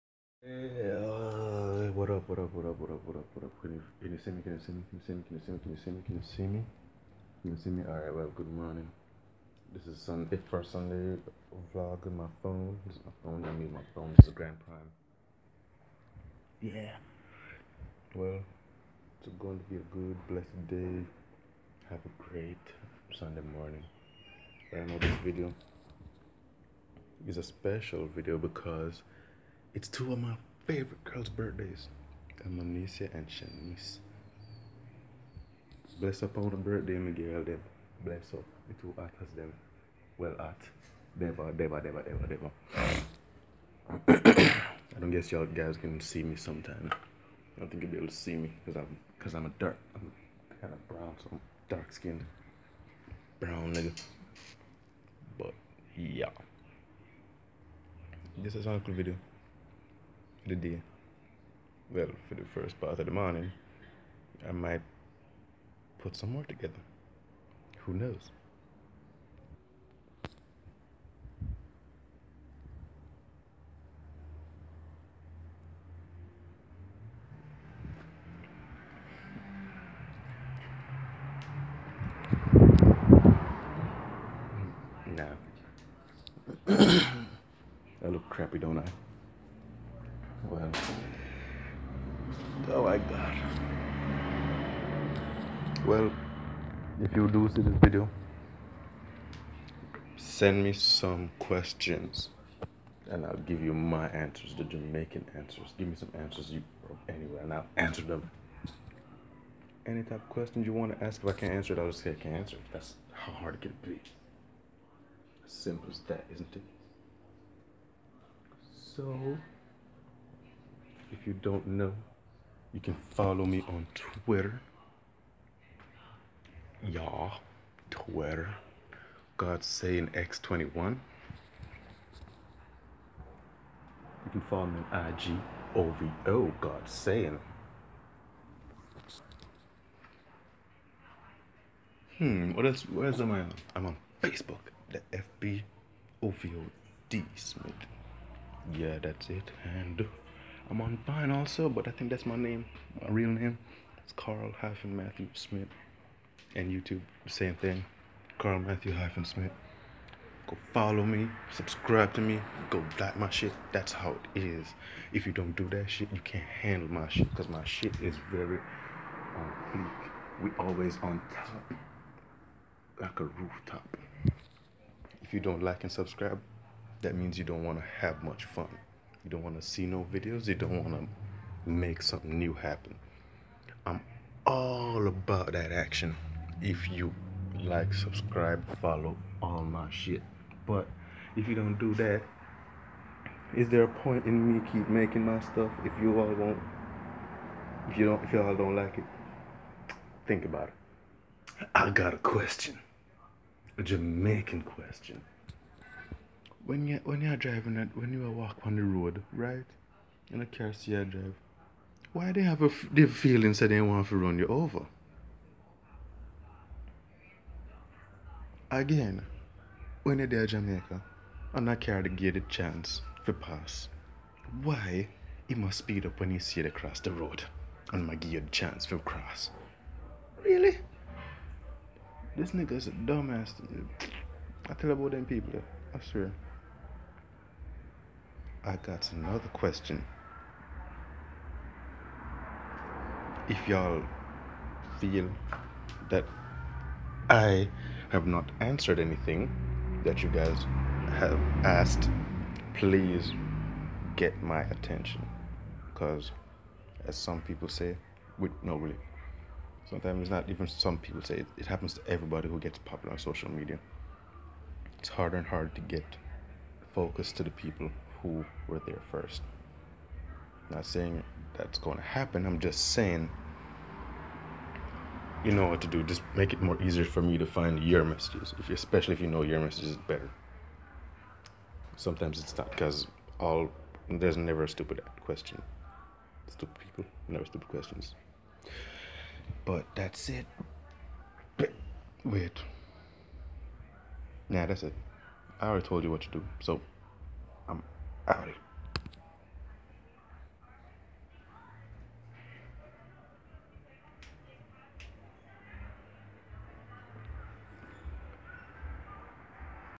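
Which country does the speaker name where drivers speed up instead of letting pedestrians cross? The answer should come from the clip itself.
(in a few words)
Jamaica.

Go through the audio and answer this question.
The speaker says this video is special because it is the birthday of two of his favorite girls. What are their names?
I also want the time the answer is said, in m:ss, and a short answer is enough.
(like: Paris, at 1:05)
Amnesia and Shanice, at 0:32.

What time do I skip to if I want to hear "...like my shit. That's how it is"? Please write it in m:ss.
2:43.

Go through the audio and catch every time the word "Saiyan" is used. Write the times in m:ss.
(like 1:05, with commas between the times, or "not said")
2:09, 2:16.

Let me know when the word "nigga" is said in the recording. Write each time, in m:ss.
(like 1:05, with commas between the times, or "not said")
0:53, 3:52.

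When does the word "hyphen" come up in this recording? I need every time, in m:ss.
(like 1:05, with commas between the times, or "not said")
2:34, 2:38.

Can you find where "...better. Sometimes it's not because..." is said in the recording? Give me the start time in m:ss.
4:40.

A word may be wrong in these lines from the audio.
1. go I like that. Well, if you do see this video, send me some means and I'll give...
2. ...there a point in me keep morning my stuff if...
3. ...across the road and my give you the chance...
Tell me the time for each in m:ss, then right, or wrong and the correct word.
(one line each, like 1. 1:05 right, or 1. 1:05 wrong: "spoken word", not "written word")
1. 1:30 wrong: "questions", not "means"
2. 3:13 wrong: "making", not "morning"
3. 3:46 right.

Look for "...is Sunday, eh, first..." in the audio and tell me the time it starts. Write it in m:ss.
0:09.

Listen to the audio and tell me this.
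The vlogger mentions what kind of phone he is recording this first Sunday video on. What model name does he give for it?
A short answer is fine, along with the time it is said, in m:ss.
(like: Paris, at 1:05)
Grand Prime, at 0:14.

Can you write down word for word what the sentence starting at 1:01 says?
Well, for the first part of the morning, I might put some more together.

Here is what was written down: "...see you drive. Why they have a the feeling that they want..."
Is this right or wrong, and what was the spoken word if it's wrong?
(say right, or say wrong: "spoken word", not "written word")
right.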